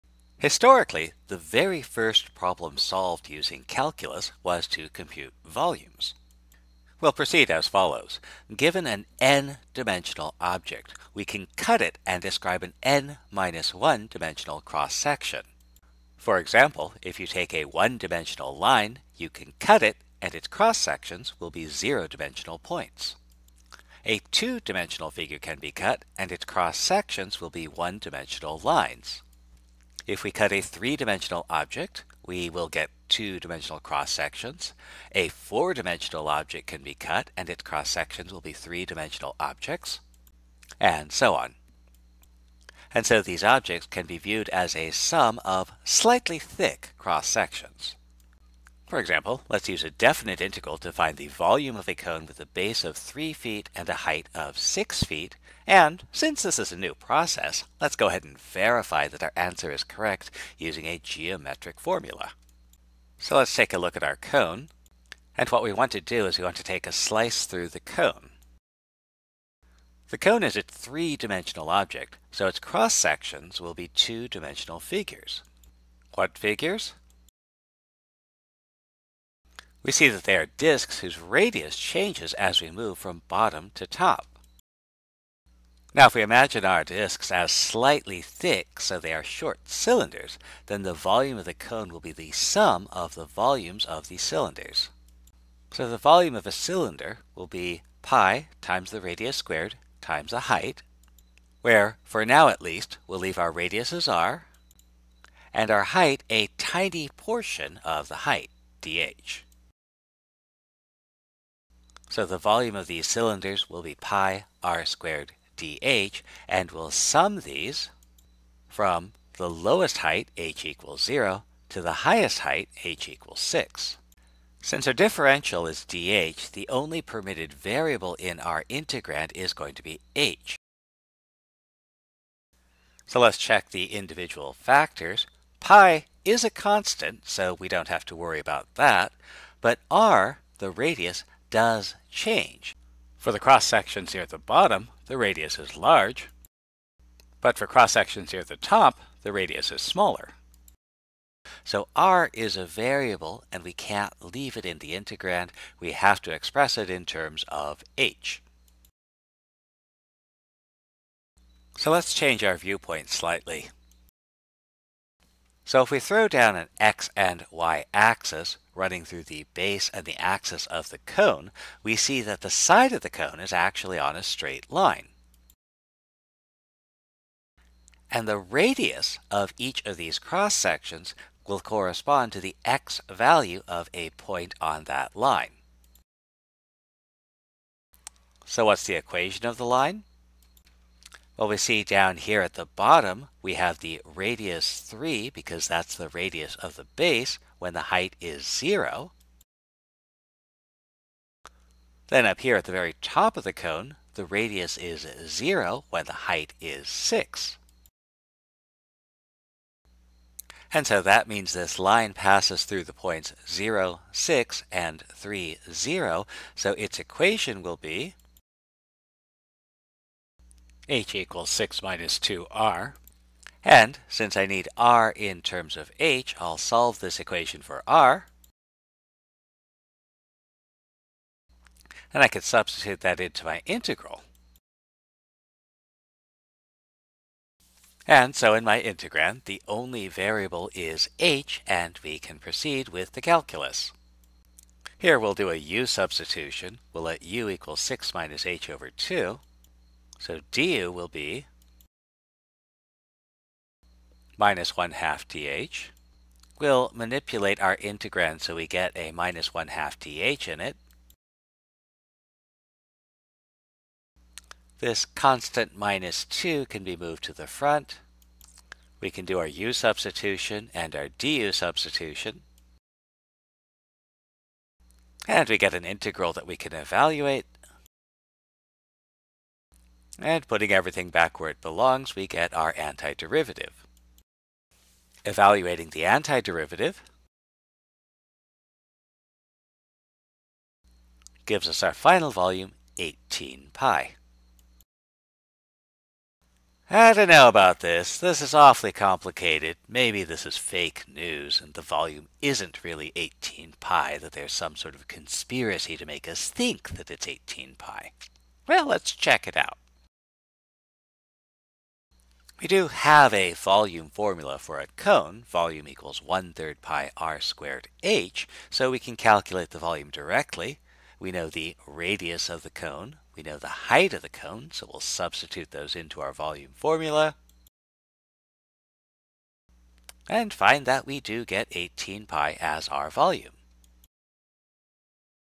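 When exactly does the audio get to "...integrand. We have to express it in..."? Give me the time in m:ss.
2:34.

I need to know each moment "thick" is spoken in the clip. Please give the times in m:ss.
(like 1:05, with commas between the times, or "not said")
0:46, 1:28.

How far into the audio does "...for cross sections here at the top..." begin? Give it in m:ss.
2:27.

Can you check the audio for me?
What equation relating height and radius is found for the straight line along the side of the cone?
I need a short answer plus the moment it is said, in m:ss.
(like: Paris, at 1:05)
h = 6 - 2r, at 3:40.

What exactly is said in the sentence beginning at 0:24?
A two-dimensional figure can be cut and its cross-sections will be one-dimensional lines.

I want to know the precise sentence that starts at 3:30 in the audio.
And so that means this line passes through the points 0, 6, and 3, 0.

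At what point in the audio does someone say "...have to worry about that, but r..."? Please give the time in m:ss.
2:17.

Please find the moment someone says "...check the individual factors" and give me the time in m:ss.
2:13.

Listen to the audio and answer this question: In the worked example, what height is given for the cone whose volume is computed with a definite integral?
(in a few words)
6 feet.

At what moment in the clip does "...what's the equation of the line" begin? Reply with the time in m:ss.
3:08.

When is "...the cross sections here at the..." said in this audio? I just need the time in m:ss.
2:23.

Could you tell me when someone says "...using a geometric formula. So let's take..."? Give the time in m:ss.
1:00.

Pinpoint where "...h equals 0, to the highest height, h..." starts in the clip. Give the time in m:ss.
2:00.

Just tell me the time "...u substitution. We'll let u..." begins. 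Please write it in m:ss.
4:05.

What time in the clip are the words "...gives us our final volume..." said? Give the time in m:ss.
4:51.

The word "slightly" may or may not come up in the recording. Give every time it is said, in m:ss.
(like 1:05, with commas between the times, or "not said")
0:45, 1:27, 2:43.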